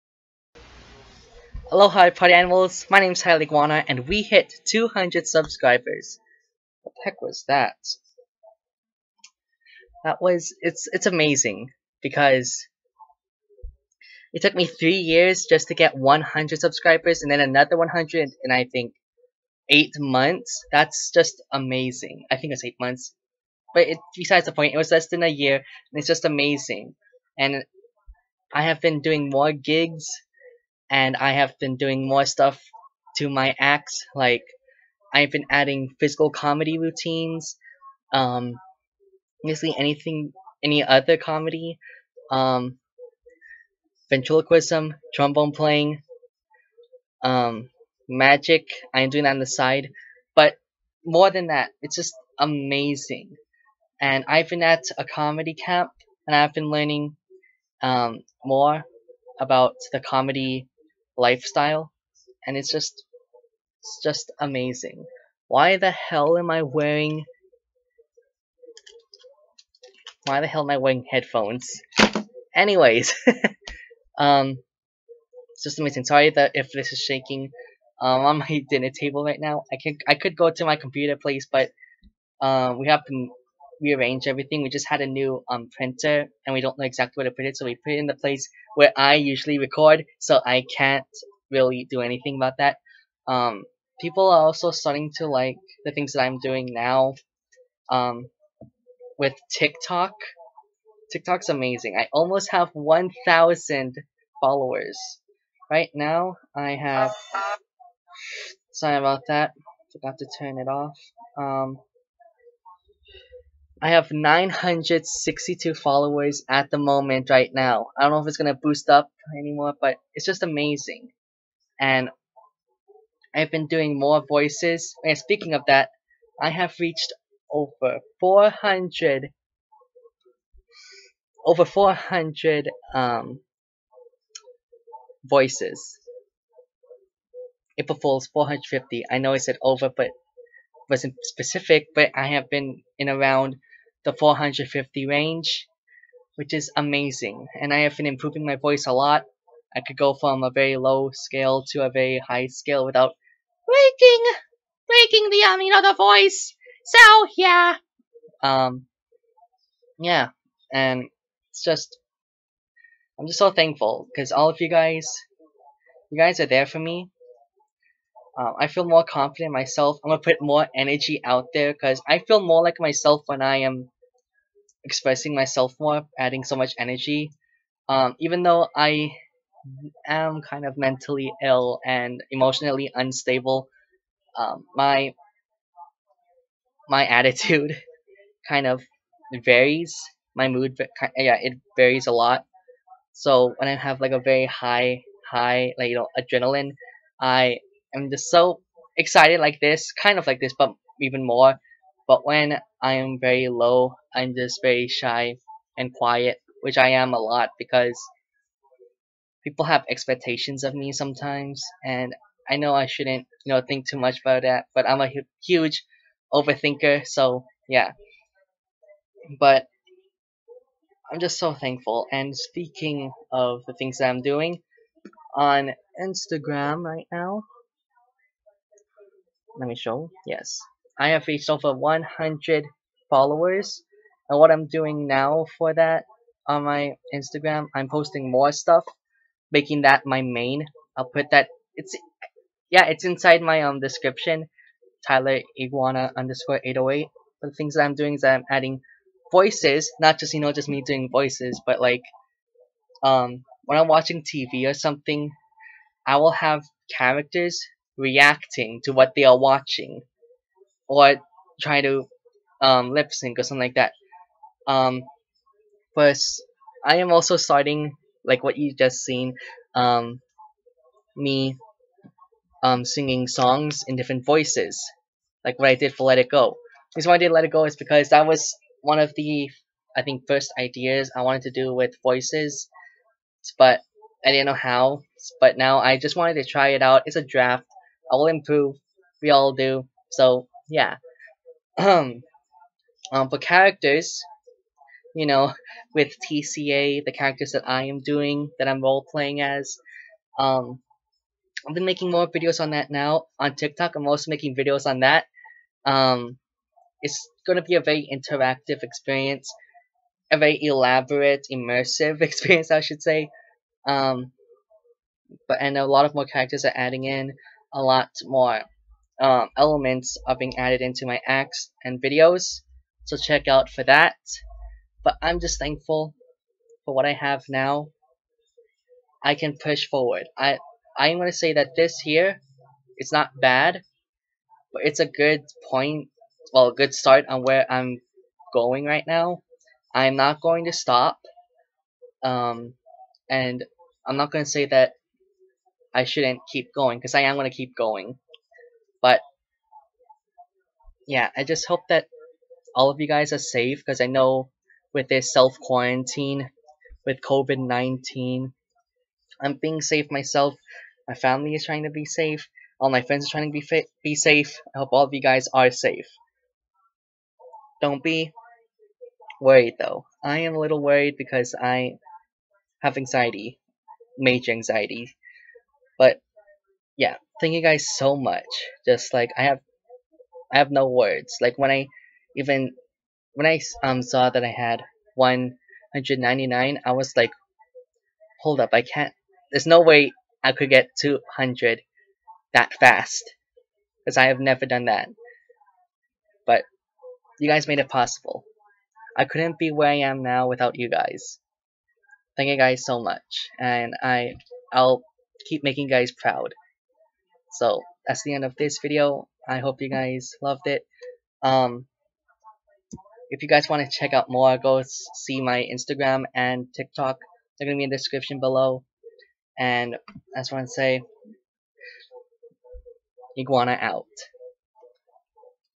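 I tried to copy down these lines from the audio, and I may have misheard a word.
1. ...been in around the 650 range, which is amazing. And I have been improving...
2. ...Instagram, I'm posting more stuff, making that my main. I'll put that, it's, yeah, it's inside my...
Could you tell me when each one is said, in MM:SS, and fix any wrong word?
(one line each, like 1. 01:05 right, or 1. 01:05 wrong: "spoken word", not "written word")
1. 02:22 wrong: "450", not "650"
2. 03:57 right.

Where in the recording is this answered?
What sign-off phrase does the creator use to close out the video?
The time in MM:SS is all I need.
07:03.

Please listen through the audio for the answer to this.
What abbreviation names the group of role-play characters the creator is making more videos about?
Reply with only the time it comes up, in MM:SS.
04:56.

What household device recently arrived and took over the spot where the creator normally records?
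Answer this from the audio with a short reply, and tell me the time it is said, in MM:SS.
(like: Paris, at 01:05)
printer, at 01:25.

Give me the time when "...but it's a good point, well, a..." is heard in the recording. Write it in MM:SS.
05:34.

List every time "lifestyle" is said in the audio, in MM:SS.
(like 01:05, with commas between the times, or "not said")
01:01.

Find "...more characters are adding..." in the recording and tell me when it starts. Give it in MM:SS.
05:16.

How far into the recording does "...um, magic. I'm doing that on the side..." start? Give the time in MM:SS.
00:47.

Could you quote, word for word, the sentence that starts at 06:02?
All my friends are trying to be fit, be safe.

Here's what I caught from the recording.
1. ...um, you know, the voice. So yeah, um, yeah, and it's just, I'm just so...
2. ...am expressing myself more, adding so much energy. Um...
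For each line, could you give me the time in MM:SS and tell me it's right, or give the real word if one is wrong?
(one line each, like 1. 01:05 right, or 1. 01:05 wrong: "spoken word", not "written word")
1. 02:35 right
2. 02:53 right.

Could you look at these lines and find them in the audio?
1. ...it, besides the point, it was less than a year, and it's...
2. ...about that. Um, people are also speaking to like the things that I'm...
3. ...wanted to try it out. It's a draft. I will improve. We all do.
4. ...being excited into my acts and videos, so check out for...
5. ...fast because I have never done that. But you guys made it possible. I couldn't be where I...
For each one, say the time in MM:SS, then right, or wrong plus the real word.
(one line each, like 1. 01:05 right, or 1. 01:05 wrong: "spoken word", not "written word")
1. 00:23 right
2. 01:32 wrong: "starting", not "speaking"
3. 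04:46 right
4. 05:20 wrong: "added", not "excited"
5. 06:32 right.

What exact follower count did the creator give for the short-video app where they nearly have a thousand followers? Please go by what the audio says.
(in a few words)
962.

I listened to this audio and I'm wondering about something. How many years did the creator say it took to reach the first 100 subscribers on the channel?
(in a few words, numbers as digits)
3.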